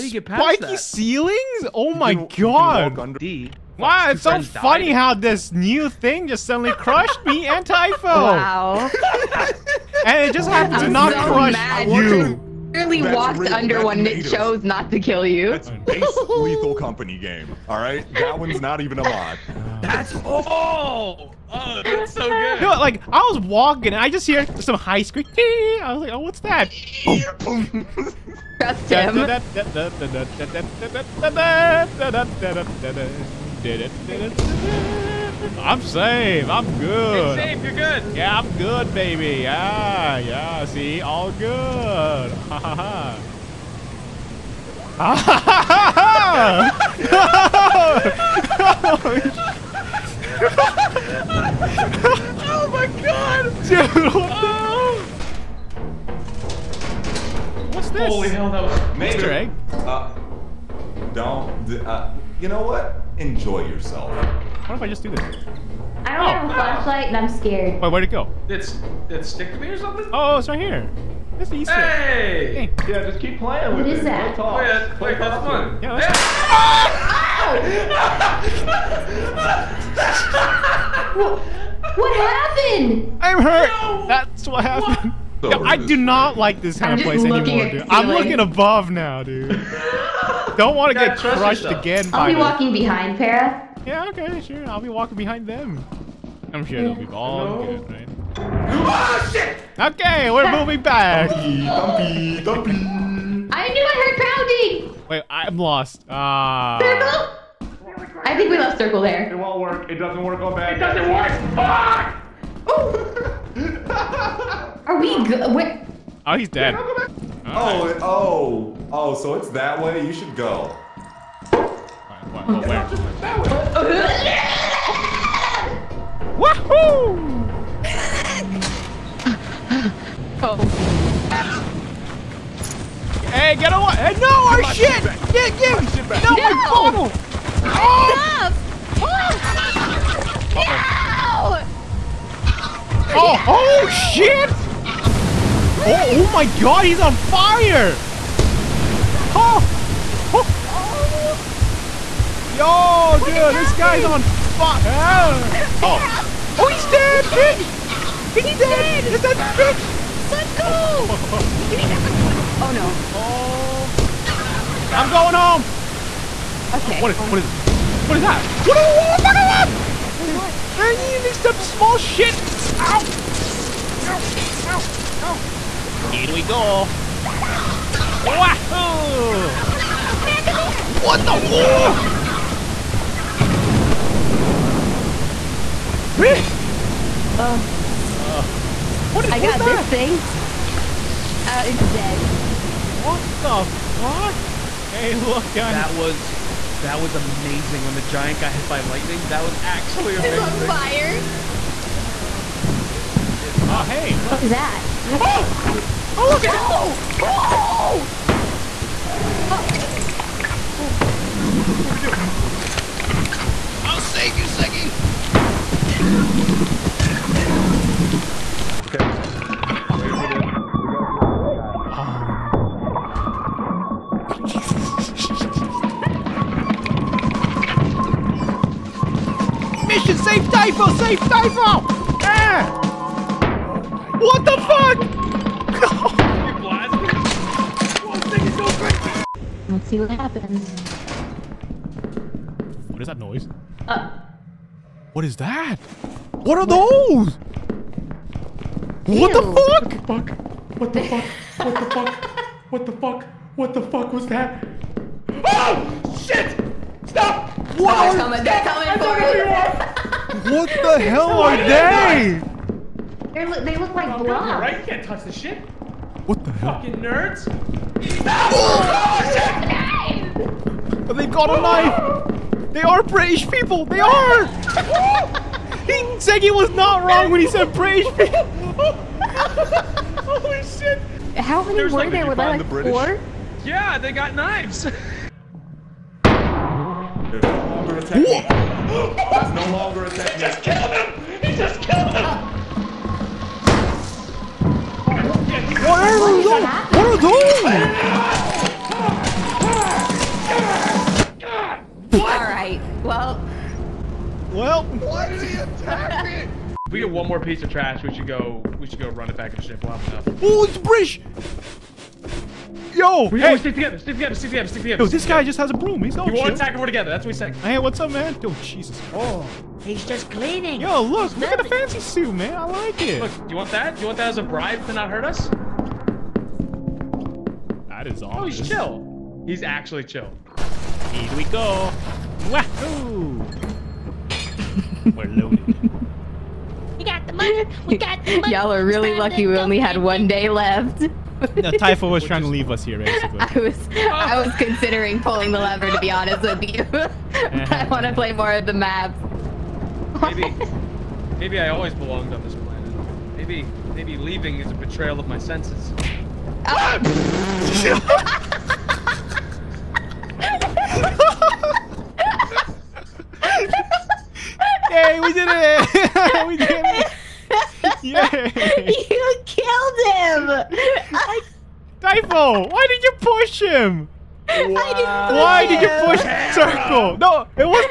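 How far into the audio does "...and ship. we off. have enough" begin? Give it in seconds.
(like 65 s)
309 s.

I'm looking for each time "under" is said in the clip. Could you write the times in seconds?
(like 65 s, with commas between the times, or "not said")
2 s, 13 s.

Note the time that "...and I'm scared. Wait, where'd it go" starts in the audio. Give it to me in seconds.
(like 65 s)
67 s.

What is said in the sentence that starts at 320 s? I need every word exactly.
Yo, look, he's look at the fancy suit, man.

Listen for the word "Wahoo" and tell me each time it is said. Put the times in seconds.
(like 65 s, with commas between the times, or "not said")
178 s, 332 s.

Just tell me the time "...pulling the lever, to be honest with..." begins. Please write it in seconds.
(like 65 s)
345 s.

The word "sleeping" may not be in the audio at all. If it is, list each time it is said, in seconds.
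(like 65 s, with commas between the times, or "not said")
not said.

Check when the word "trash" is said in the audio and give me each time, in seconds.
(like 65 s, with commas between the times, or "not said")
307 s.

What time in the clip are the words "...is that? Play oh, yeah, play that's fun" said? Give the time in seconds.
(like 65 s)
73 s.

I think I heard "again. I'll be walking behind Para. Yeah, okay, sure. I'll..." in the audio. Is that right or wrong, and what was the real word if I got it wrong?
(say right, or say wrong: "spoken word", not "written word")
right.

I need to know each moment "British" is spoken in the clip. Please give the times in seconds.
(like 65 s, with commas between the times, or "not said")
273 s, 277 s, 282 s.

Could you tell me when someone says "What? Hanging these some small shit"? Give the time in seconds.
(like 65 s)
170 s.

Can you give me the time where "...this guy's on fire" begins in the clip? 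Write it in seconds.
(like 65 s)
153 s.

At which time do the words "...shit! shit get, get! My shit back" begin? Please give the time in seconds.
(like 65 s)
134 s.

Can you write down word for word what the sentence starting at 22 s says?
No, like I was walking and I just hear some high scream.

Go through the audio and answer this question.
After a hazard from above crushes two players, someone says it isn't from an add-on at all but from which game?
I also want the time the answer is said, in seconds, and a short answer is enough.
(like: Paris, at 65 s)
Lethal Company, at 16 s.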